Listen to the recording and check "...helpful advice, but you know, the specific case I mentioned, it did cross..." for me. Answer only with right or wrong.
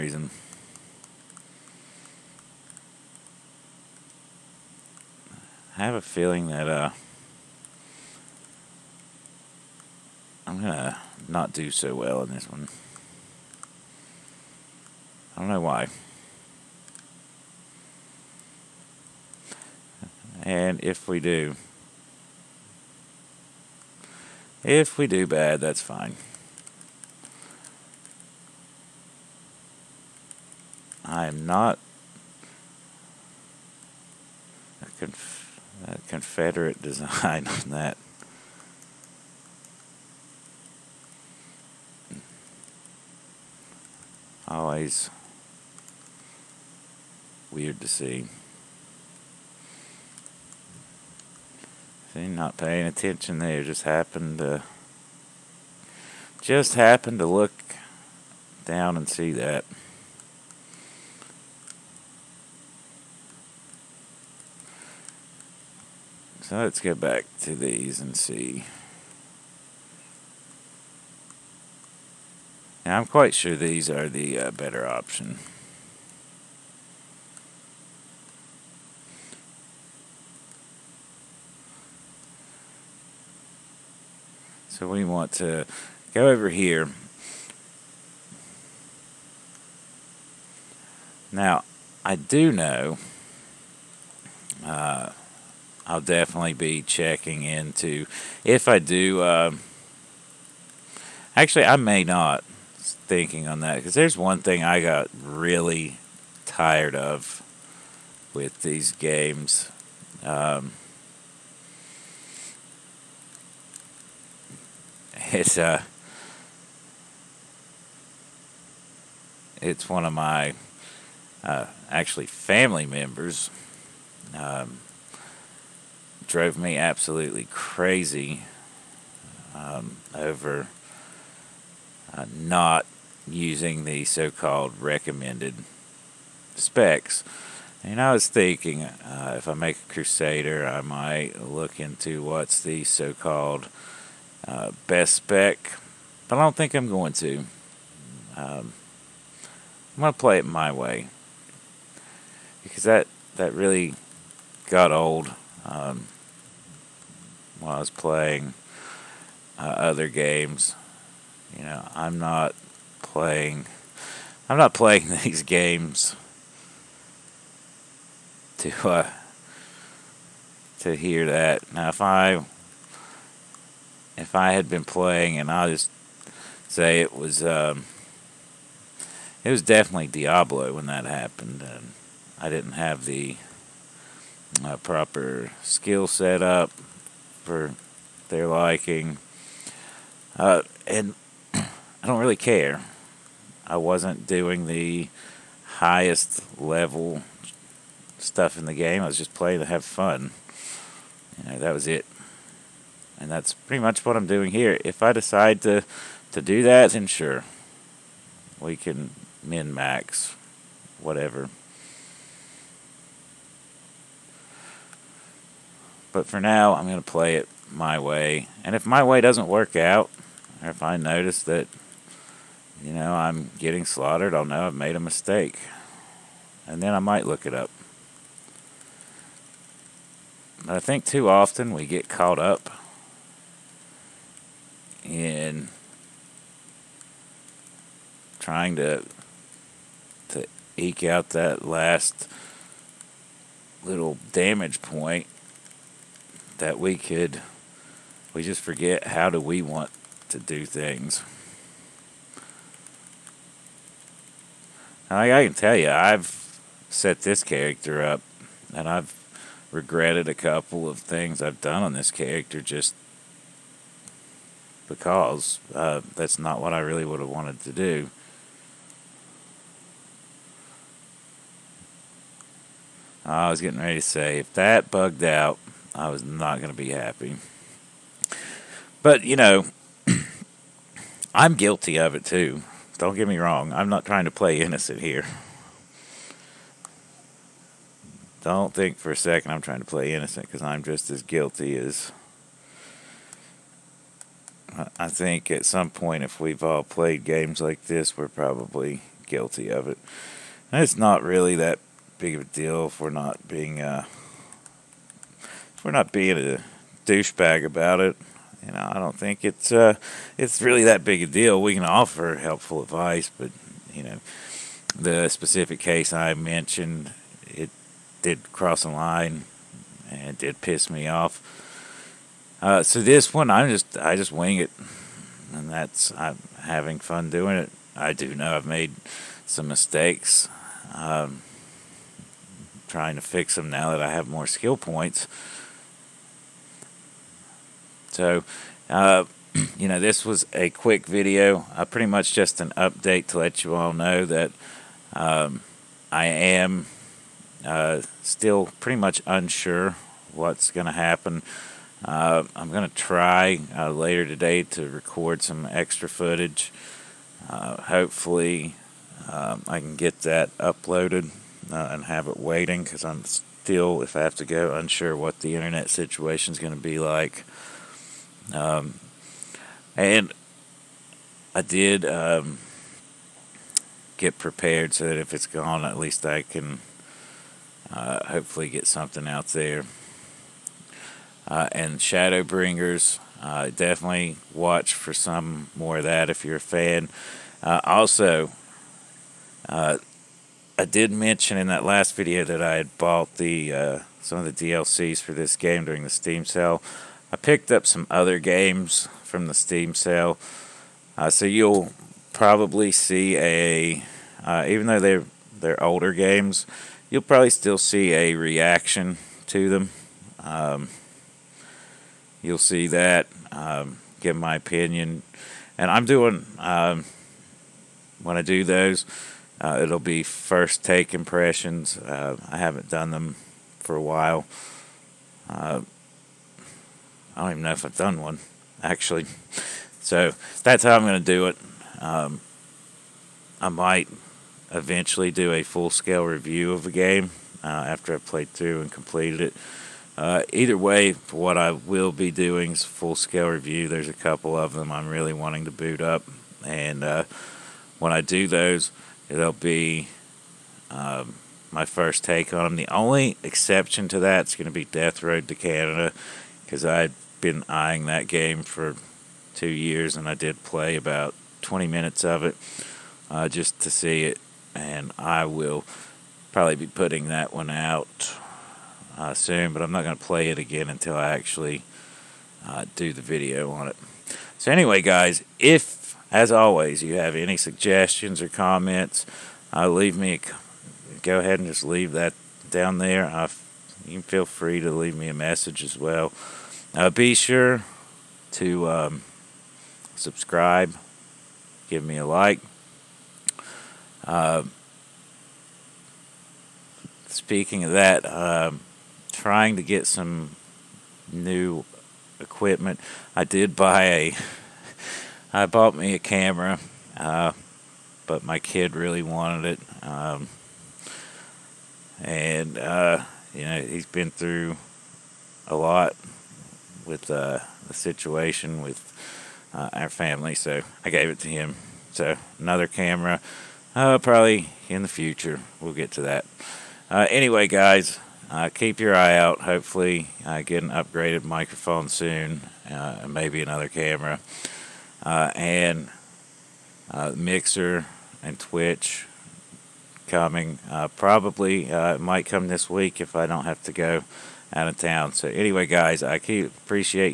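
right.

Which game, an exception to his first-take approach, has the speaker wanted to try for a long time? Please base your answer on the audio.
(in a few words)
Death Road to Canada.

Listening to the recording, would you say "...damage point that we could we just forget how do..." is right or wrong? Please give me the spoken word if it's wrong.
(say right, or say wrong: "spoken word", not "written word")
right.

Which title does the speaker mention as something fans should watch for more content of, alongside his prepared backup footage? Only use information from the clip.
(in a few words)
Shadowbringers.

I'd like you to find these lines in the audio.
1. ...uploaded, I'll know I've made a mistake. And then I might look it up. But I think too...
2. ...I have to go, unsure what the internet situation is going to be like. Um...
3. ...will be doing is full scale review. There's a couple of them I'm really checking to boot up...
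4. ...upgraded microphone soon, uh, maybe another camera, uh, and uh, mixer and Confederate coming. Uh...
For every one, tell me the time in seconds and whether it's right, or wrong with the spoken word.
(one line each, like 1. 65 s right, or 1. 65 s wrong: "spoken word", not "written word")
1. 223 s wrong: "slaughtered", not "uploaded"
2. 364 s right
3. 441 s wrong: "wanting", not "checking"
4. 530 s wrong: "Twitch", not "Confederate".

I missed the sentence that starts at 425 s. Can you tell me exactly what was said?
Uh, I don't even know if I've done one, actually.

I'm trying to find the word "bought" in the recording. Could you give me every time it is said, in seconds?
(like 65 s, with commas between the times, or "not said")
392 s, 505 s.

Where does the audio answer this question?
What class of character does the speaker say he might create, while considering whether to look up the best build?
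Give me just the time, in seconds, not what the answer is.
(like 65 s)
139 s.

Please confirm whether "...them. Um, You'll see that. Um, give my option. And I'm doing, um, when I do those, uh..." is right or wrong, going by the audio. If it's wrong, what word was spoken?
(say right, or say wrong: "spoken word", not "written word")
wrong: "opinion", not "option".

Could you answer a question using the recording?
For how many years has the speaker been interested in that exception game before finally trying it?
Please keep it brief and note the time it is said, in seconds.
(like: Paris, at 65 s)
2, at 459 s.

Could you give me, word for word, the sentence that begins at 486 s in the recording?
Uh, be sure to um, subscribe, give me a like.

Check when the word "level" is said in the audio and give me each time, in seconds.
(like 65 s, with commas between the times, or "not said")
196 s.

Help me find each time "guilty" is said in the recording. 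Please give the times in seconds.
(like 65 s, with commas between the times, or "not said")
281 s, 291 s, 299 s.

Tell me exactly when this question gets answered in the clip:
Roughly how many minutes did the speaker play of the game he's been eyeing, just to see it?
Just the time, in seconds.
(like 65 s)
461 s.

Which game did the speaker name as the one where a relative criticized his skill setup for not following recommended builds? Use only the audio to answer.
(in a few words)
Diablo.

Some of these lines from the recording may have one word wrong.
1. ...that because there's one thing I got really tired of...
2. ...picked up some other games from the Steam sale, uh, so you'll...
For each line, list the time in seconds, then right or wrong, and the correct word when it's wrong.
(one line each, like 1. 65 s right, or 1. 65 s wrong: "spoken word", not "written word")
1. 103 s right
2. 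397 s right.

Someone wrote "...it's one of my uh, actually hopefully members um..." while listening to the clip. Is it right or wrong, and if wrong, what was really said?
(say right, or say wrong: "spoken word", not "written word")
wrong: "family", not "hopefully".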